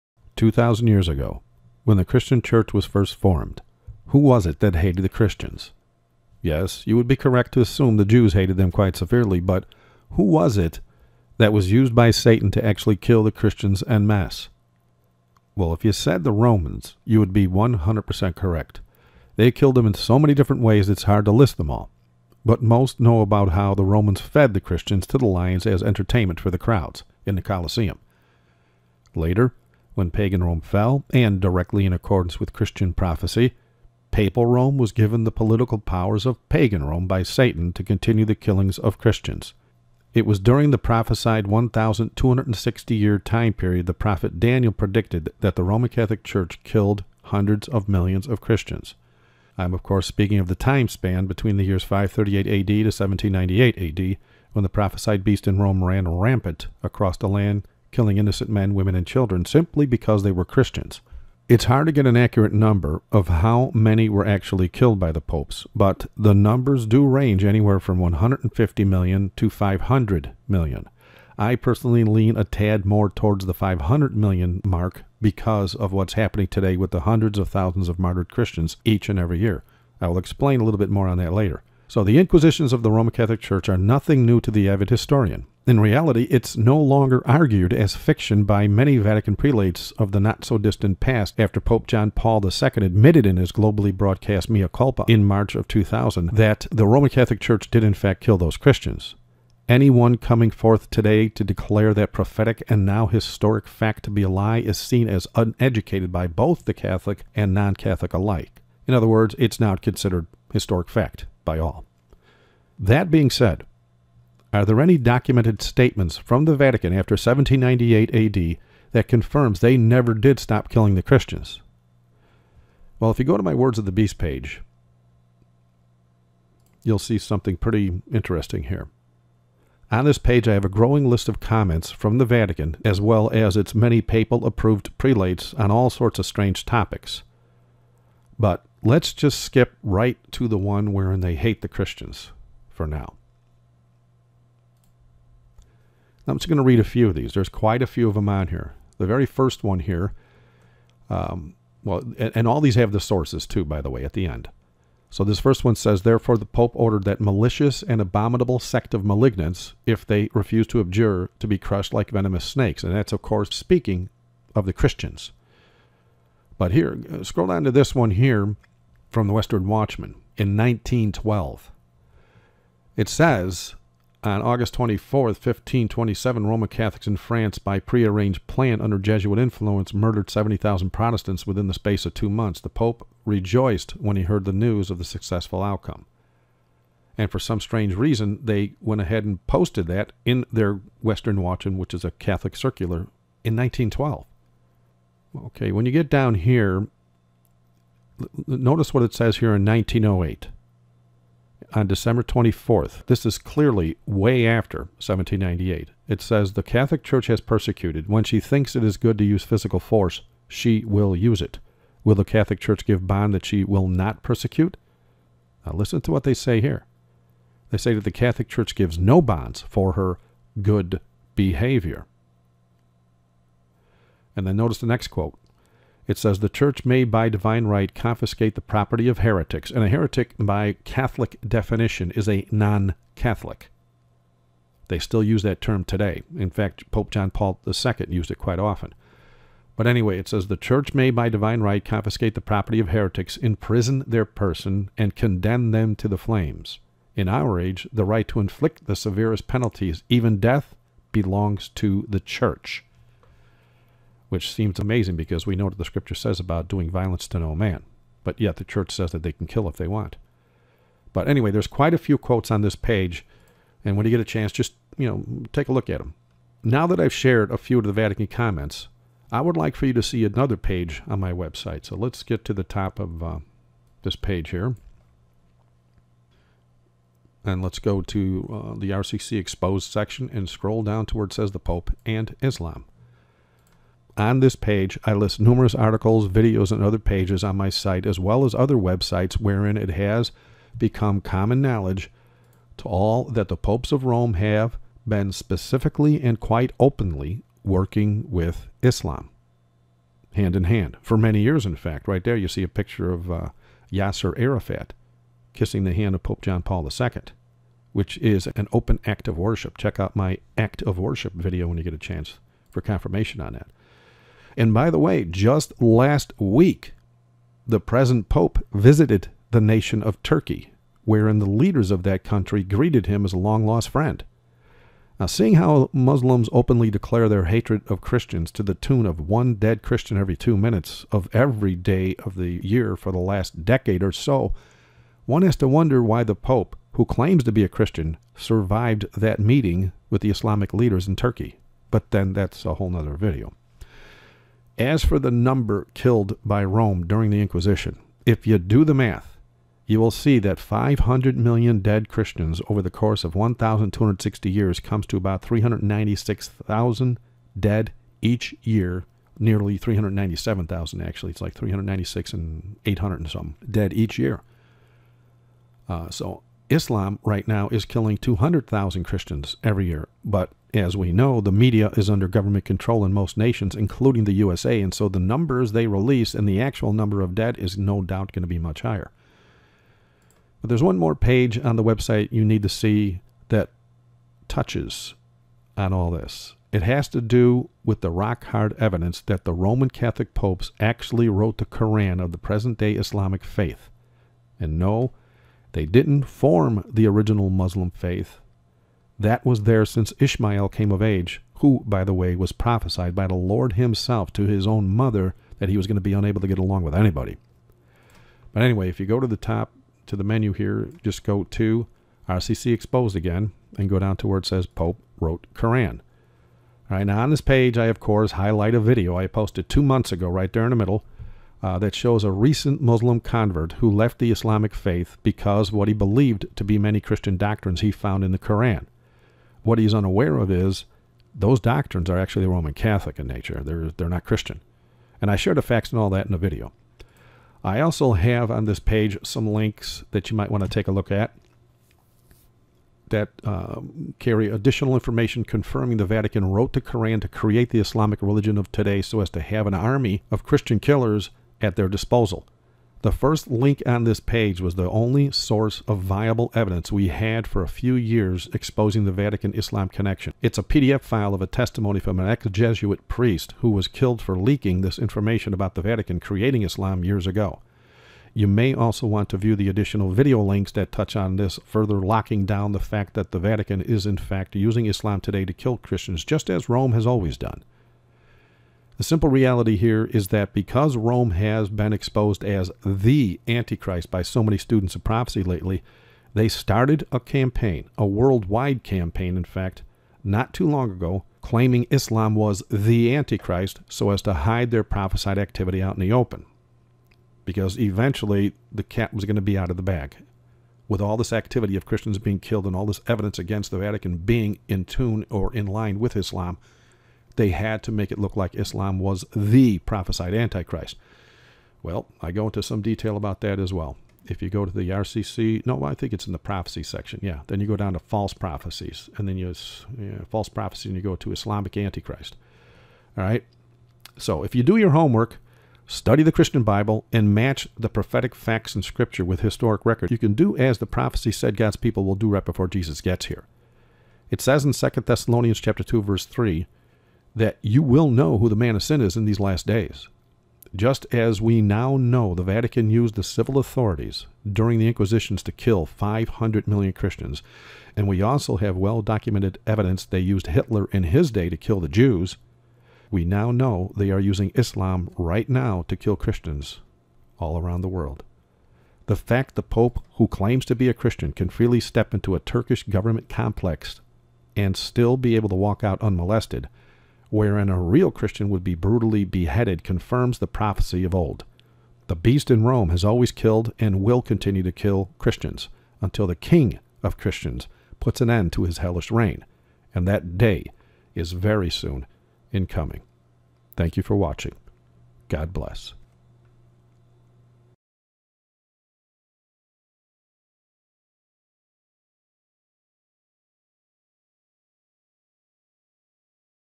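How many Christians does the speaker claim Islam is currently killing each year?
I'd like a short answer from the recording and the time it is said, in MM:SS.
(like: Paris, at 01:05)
200,000, at 06:08.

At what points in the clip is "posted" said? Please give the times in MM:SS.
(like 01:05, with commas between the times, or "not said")
03:09, 06:59.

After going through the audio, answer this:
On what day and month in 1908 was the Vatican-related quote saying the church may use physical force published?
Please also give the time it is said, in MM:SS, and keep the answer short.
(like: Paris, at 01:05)
December 24, at 03:21.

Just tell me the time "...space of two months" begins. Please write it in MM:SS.
03:01.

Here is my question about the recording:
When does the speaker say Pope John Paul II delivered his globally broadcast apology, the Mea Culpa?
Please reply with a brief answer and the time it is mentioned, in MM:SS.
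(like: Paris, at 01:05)
March 2000, at 01:35.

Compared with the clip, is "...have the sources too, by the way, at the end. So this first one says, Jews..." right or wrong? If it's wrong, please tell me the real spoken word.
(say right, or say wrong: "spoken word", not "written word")
wrong: "Therefore", not "Jews".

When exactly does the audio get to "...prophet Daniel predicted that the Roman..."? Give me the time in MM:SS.
00:43.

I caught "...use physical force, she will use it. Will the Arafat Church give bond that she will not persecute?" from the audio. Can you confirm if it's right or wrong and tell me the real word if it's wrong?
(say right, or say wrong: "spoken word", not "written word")
wrong: "Catholic", not "Arafat".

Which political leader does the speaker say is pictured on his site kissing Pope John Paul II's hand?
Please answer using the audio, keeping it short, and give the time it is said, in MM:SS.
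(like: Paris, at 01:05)
Yasser Arafat, at 05:03.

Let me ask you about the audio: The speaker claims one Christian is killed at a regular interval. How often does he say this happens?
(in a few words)
Every 2 minutes.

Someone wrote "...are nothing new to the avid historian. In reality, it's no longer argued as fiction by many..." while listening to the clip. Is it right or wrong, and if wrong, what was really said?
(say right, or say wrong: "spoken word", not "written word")
right.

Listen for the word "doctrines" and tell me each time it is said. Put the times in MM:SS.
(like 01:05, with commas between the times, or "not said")
07:07, 07:11.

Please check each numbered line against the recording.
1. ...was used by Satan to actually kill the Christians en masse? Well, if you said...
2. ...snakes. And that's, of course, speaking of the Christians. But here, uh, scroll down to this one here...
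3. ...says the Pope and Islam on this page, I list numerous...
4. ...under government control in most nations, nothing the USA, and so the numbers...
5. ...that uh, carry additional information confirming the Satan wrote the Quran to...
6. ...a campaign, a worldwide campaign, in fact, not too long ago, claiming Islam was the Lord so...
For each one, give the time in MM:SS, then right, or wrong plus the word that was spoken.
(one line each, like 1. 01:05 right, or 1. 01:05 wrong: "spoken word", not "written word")
1. 00:11 right
2. 02:42 right
3. 04:41 right
4. 06:12 wrong: "including", not "nothing"
5. 07:23 wrong: "Vatican", not "Satan"
6. 08:07 wrong: "Antichrist", not "Lord".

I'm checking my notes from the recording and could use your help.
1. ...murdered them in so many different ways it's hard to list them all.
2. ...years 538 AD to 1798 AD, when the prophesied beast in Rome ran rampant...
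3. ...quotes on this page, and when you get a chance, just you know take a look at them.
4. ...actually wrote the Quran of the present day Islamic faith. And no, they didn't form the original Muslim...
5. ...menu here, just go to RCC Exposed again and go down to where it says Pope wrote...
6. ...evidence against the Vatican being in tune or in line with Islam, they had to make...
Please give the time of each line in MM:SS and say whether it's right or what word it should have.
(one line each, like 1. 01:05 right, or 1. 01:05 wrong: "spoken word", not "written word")
1. 00:19 wrong: "killed", not "murdered"
2. 00:51 right
3. 04:22 right
4. 06:30 wrong: "Koran", not "Quran"
5. 06:50 right
6. 08:23 right.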